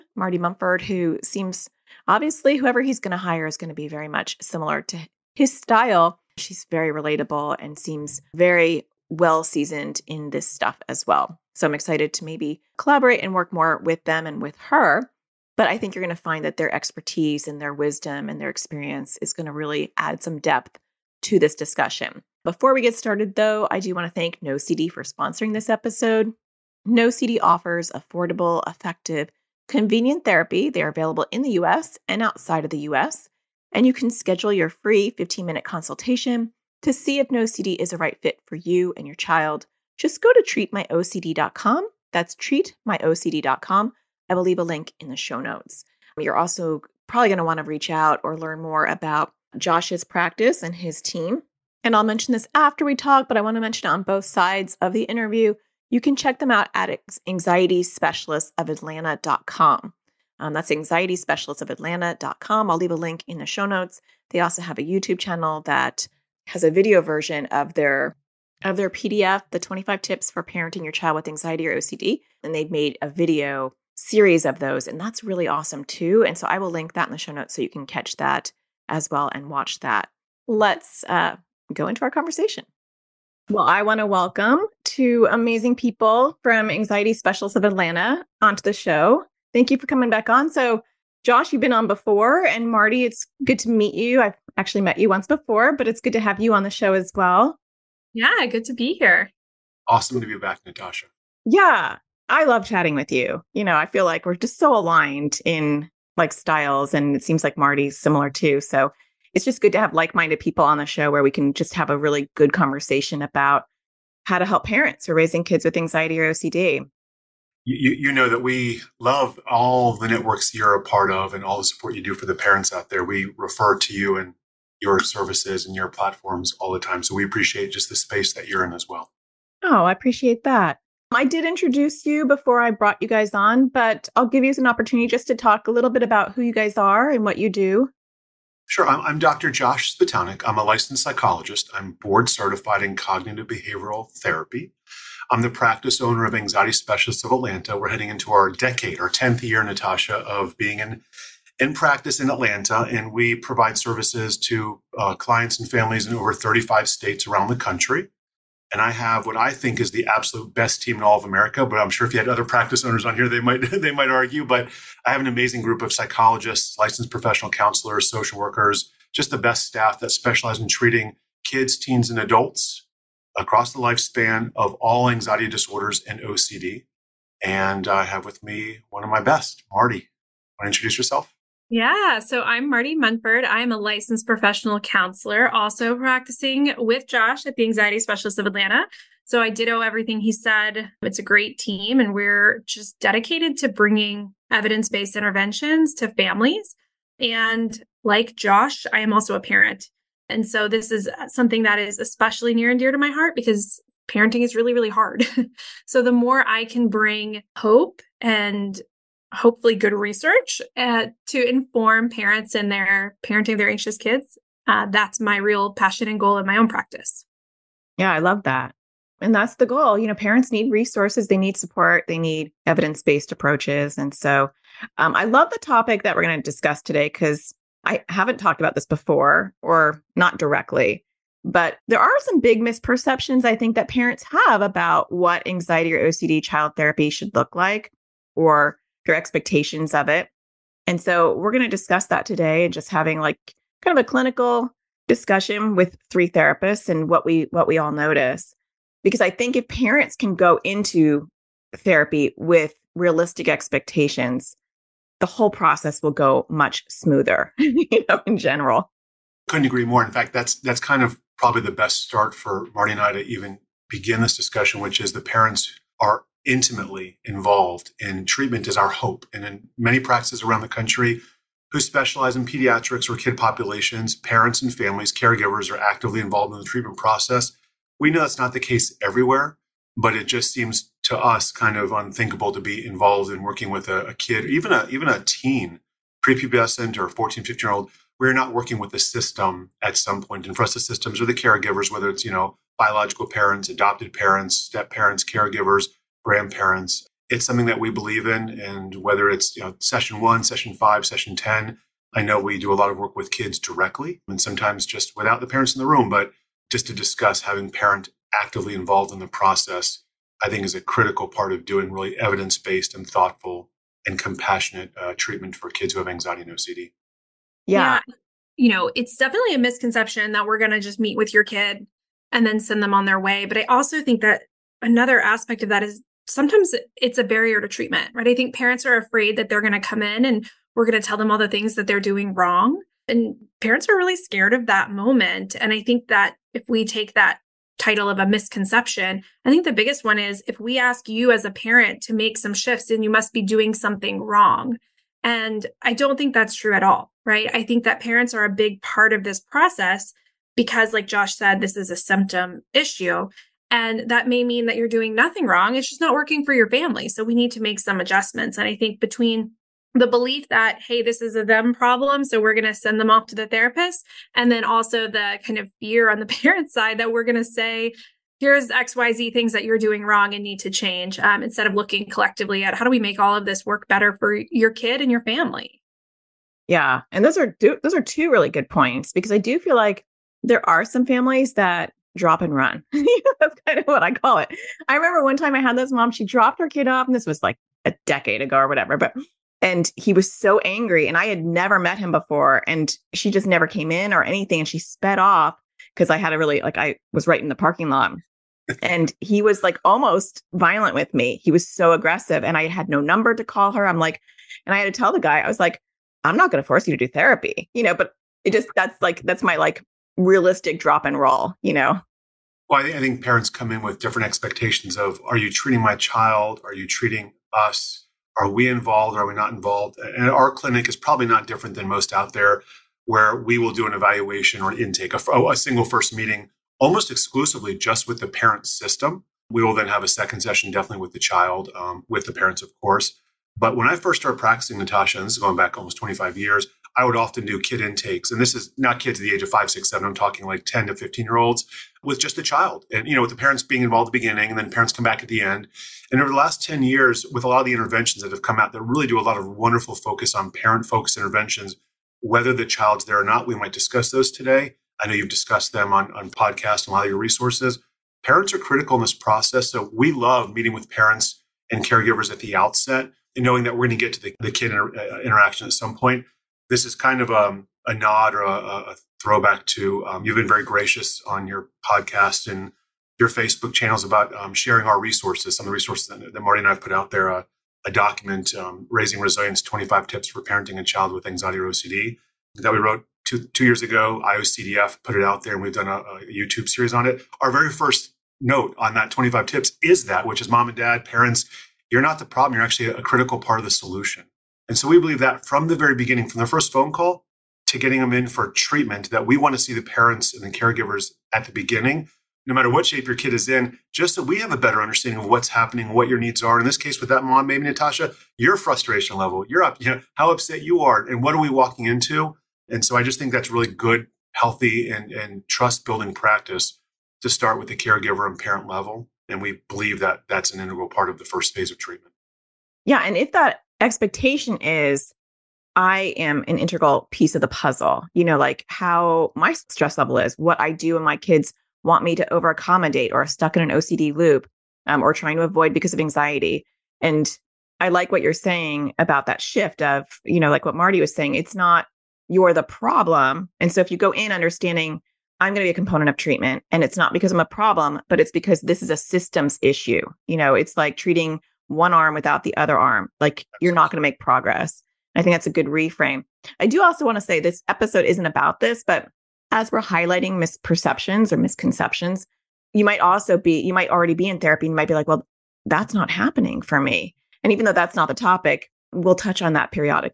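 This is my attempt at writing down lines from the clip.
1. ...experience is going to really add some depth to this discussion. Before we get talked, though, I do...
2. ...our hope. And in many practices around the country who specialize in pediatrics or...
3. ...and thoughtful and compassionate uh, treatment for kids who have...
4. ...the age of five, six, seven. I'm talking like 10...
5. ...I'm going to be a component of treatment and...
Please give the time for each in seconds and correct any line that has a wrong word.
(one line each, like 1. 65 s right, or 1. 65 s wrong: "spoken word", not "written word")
1. 18 s wrong: "started", not "talked"
2. 268 s right
3. 312 s right
4. 439 s right
5. 545 s right.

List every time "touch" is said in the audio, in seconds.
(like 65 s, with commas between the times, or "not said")
569 s.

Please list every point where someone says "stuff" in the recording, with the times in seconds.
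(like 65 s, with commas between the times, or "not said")
10 s.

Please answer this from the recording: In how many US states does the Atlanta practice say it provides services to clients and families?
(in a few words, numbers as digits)
over 35.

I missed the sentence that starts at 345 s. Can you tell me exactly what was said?
And I don't think that's true at all, right?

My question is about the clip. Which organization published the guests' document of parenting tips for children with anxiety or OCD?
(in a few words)
IOCDF.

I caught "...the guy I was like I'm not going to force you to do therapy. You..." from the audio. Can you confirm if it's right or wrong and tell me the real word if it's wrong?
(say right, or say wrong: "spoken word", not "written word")
right.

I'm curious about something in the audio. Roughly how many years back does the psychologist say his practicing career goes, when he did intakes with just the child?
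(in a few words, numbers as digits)
almost 25 years.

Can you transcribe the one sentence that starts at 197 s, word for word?
And like Josh, I am also a parent.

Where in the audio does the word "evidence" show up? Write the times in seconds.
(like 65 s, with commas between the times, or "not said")
194 s, 222 s, 312 s.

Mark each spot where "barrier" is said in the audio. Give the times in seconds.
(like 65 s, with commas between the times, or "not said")
327 s.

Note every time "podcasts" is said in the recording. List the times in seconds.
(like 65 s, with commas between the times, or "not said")
456 s, 471 s.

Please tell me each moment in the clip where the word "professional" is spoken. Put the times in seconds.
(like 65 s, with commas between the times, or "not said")
167 s, 184 s.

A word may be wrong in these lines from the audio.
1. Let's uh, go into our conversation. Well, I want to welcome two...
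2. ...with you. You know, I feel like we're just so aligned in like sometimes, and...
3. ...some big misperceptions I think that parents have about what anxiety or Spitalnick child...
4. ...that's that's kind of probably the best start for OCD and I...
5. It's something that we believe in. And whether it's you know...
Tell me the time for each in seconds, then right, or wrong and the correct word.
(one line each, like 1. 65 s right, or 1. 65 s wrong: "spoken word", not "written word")
1. 80 s right
2. 102 s wrong: "styles", not "sometimes"
3. 232 s wrong: "OCD", not "Spitalnick"
4. 260 s wrong: "Marti", not "OCD"
5. 297 s right.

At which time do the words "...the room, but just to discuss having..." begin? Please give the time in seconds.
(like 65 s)
305 s.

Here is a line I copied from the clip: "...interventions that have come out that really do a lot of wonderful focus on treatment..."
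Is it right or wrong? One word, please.
wrong.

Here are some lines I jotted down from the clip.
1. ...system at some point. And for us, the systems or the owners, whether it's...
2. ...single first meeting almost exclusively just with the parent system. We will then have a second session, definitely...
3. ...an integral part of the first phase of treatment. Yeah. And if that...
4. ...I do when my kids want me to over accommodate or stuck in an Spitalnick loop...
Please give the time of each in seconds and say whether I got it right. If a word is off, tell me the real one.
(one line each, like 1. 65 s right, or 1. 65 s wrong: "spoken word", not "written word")
1. 288 s wrong: "caregivers", not "owners"
2. 425 s right
3. 520 s right
4. 530 s wrong: "OCD", not "Spitalnick".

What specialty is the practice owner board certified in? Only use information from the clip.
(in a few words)
cognitive behavioral therapy.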